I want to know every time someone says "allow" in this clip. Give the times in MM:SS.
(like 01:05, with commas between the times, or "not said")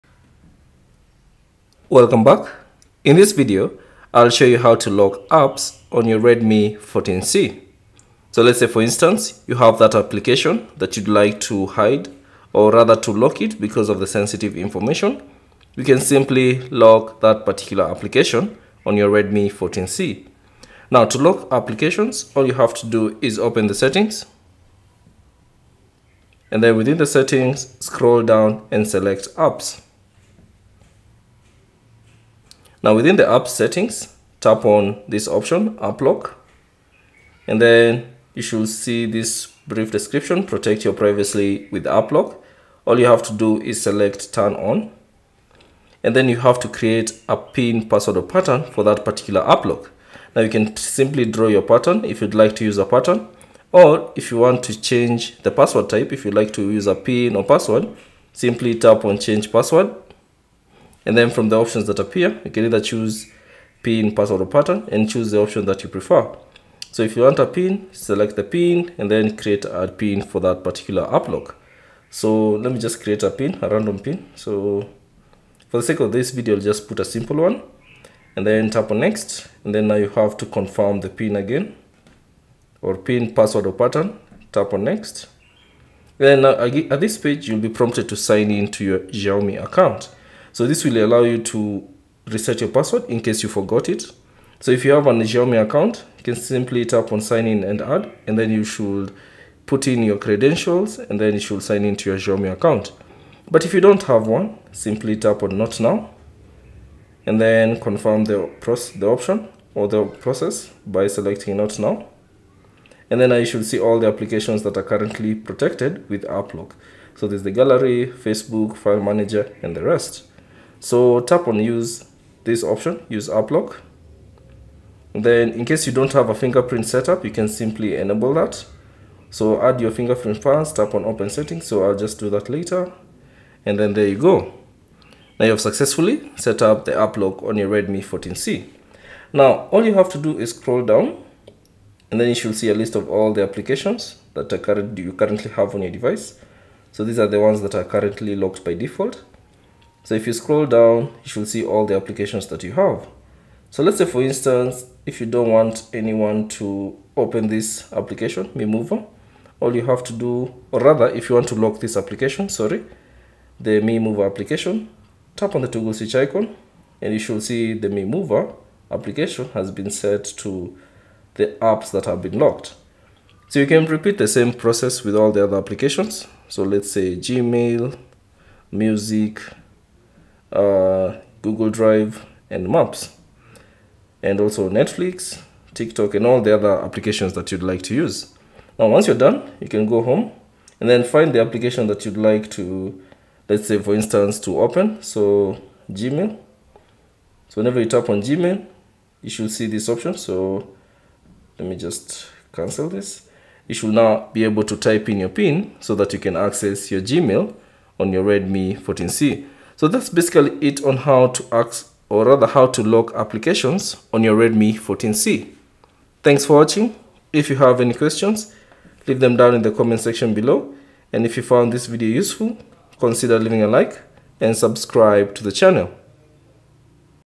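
01:30.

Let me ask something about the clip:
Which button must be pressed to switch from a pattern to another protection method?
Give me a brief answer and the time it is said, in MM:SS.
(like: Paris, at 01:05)
Change password, at 00:59.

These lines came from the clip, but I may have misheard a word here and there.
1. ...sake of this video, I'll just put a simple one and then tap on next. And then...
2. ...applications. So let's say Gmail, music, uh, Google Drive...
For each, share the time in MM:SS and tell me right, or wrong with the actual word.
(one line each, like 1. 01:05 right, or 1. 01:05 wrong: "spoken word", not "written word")
1. 01:15 right
2. 02:55 right.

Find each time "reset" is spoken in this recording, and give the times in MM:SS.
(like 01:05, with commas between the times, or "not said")
01:32.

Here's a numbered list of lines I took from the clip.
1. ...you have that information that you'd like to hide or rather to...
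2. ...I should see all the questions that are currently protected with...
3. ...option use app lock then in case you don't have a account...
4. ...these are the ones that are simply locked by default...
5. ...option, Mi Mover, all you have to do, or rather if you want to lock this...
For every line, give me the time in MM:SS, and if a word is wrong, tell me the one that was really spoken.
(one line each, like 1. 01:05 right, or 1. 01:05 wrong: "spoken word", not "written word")
1. 00:09 wrong: "application", not "information"
2. 01:53 wrong: "applications", not "questions"
3. 02:02 wrong: "fingerprint", not "account"
4. 02:27 wrong: "currently", not "simply"
5. 02:37 wrong: "application", not "option".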